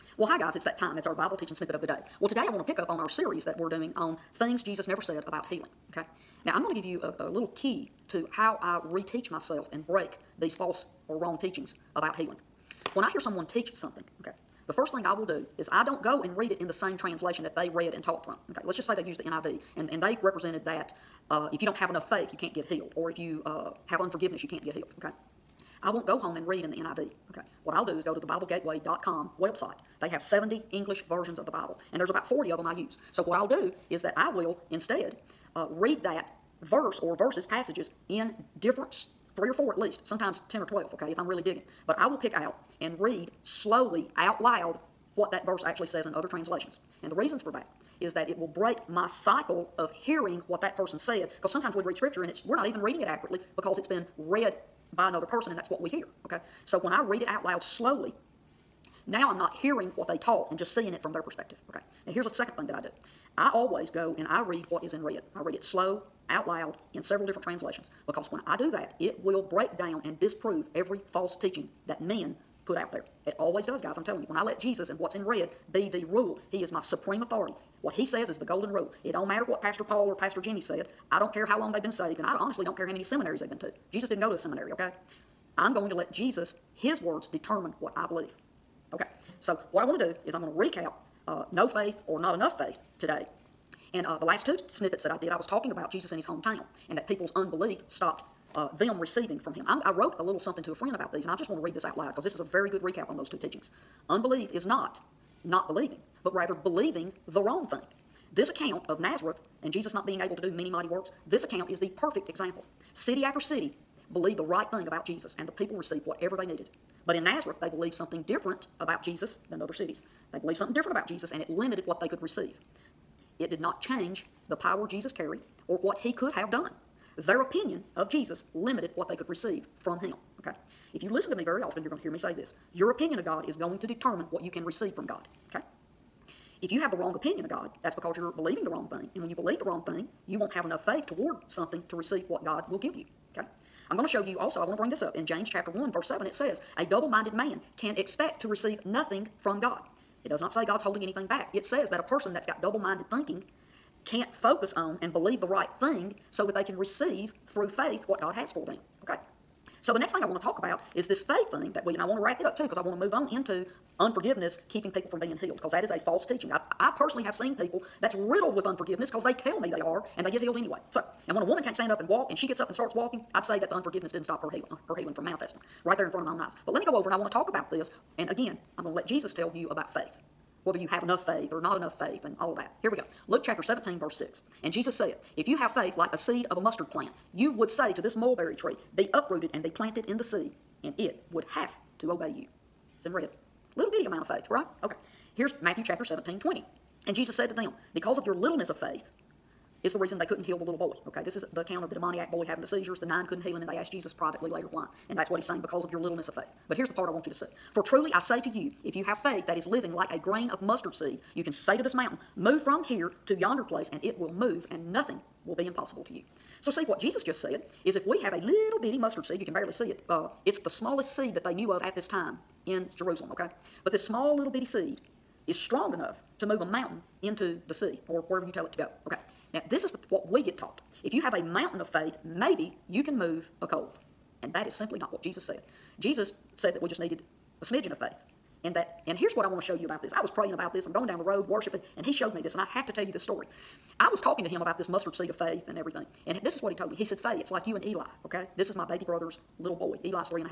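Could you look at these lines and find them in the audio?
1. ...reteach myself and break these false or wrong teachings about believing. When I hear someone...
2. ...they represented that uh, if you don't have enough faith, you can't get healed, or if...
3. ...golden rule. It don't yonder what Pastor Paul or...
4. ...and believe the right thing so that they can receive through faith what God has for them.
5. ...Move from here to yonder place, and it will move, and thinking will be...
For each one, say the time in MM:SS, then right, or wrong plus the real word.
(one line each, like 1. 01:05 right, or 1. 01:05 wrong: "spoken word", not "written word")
1. 00:08 wrong: "healing", not "believing"
2. 00:20 right
3. 01:18 wrong: "matter", not "yonder"
4. 02:35 right
5. 03:32 wrong: "nothing", not "thinking".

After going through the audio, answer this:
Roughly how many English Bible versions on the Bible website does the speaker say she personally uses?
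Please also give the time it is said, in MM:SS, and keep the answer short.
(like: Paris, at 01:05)
40, at 00:32.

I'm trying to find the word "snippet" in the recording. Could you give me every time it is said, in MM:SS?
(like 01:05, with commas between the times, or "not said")
00:01, 01:34.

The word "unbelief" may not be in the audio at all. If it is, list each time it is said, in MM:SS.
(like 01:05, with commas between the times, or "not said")
01:37, 01:44.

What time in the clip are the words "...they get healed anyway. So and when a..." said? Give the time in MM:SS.
02:50.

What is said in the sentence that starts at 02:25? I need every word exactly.
In James chapter 1, verse 7, it says, A double minded man can expect to receive nothing from God.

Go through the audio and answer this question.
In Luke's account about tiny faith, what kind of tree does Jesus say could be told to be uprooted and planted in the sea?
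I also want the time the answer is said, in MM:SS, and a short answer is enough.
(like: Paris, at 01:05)
mulberry tree, at 03:08.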